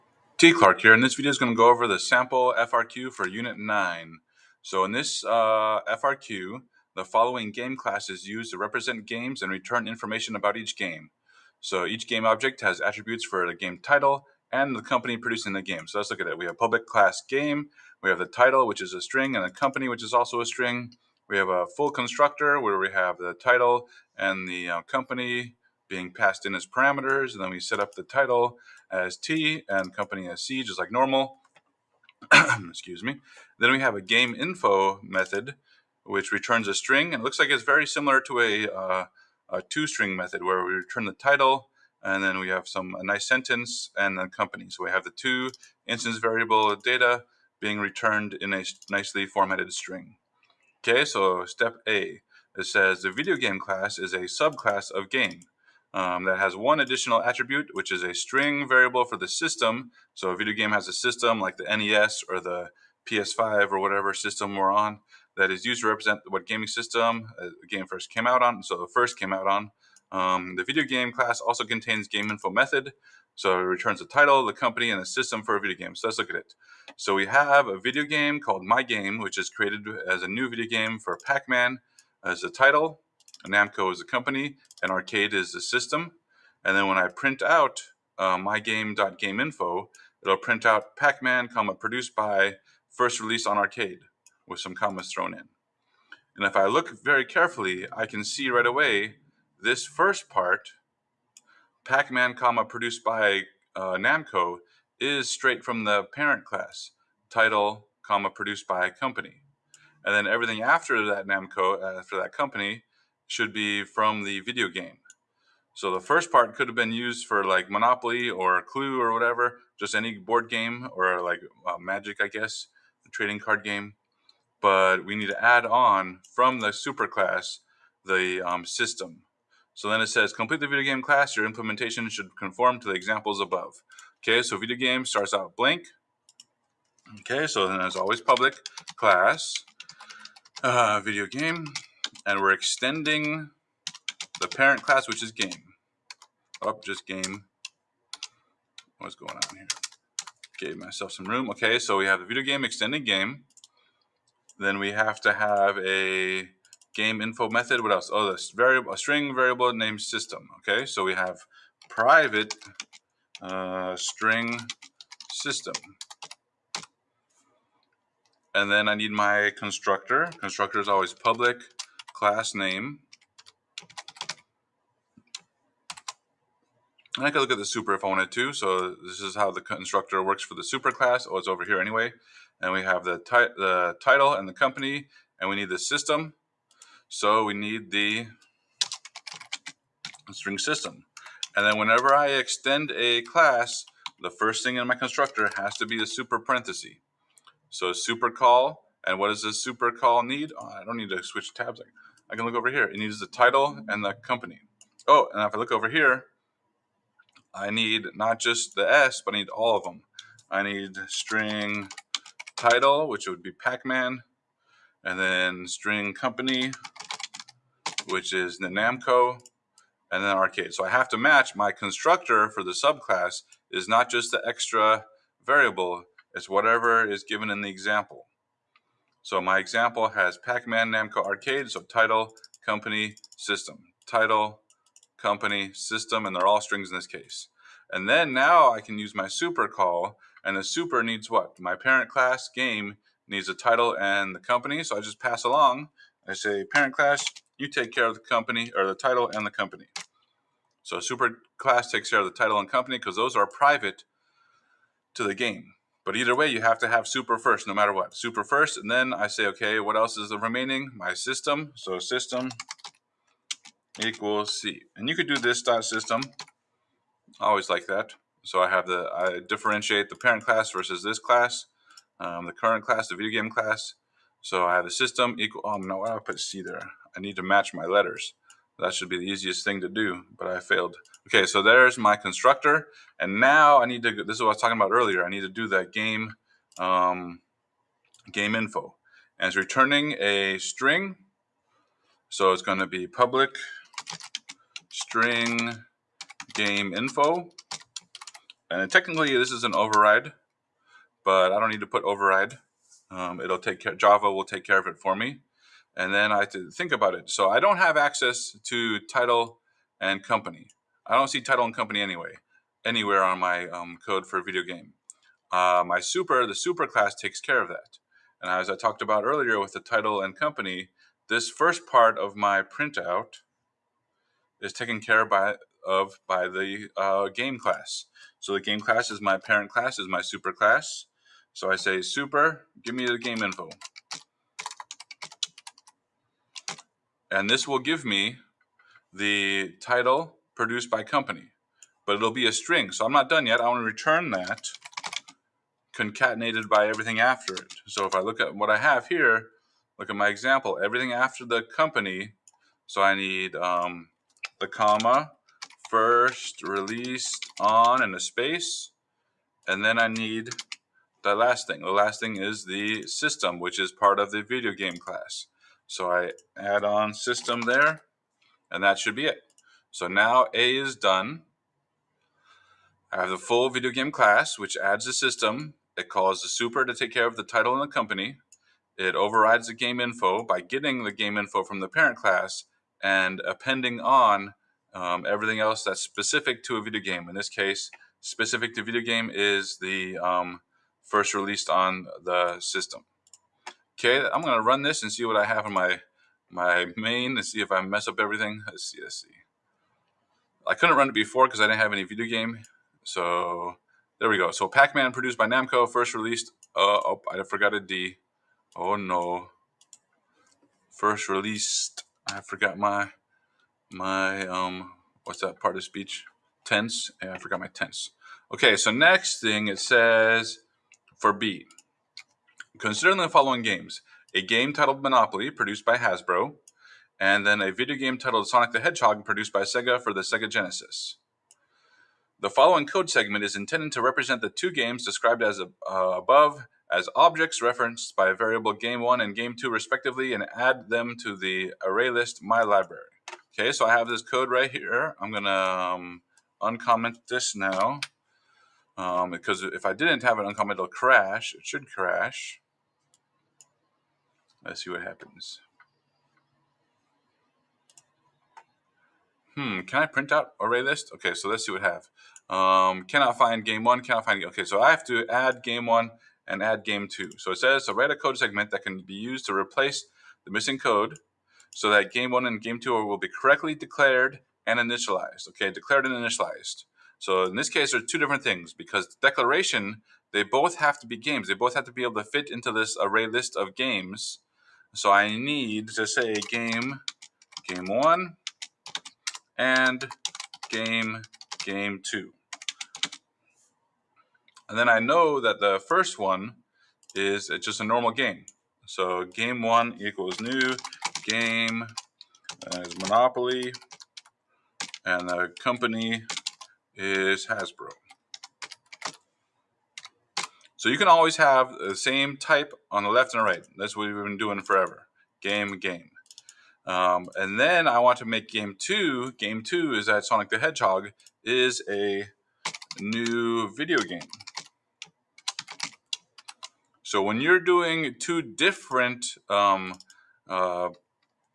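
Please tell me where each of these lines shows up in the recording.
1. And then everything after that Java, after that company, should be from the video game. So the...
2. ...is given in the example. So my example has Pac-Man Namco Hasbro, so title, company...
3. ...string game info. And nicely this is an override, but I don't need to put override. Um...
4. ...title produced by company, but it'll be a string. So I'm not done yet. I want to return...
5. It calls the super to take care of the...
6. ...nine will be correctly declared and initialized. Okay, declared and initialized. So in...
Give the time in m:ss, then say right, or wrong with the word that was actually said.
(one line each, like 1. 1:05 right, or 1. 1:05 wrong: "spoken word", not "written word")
1. 1:50 wrong: "Namco", not "Java"
2. 3:47 wrong: "Arcade", not "Hasbro"
3. 4:54 wrong: "technically", not "nicely"
4. 5:39 right
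5. 6:15 right
6. 7:52 wrong: "two", not "nine".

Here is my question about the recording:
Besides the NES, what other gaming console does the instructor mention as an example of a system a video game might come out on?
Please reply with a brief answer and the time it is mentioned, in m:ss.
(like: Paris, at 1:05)
PS5, at 1:03.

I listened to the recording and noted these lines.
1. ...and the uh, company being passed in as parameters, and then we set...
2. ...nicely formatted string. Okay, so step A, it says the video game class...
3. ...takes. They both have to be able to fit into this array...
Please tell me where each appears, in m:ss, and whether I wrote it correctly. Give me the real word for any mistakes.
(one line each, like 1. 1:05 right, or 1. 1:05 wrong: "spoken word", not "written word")
1. 0:24 right
2. 0:48 right
3. 8:01 wrong: "games", not "takes".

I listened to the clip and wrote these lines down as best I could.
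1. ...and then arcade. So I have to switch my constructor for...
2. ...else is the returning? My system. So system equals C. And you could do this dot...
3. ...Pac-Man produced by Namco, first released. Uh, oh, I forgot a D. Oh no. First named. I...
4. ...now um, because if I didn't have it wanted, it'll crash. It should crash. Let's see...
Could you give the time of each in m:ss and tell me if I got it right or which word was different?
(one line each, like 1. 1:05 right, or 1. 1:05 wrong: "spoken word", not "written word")
1. 3:40 wrong: "match", not "switch"
2. 4:19 wrong: "remaining", not "returning"
3. 6:44 wrong: "released", not "named"
4. 7:27 wrong: "uncommented", not "wanted".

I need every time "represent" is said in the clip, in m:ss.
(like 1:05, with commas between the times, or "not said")
0:08, 1:05, 7:14.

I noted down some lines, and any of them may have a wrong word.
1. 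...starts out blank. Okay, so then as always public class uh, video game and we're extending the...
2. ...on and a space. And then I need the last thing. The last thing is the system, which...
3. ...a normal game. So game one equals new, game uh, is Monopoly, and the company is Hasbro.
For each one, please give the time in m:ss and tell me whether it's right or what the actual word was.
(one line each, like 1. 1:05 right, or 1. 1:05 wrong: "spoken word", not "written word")
1. 2:15 right
2. 5:57 right
3. 8:17 right.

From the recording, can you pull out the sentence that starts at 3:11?
And then whenever I extend a class, the first thing in my constructor has to be a super parenthesis.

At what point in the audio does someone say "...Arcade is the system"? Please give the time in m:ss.
1:24.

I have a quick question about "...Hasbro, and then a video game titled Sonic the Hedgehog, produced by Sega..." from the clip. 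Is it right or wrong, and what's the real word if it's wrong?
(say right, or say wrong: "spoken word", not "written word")
right.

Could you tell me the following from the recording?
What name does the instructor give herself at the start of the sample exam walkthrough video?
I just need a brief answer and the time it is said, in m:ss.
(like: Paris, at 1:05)
T. Clark, at 0:00.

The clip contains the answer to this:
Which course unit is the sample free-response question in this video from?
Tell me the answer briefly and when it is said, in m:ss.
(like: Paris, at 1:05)
Unit 9, at 0:03.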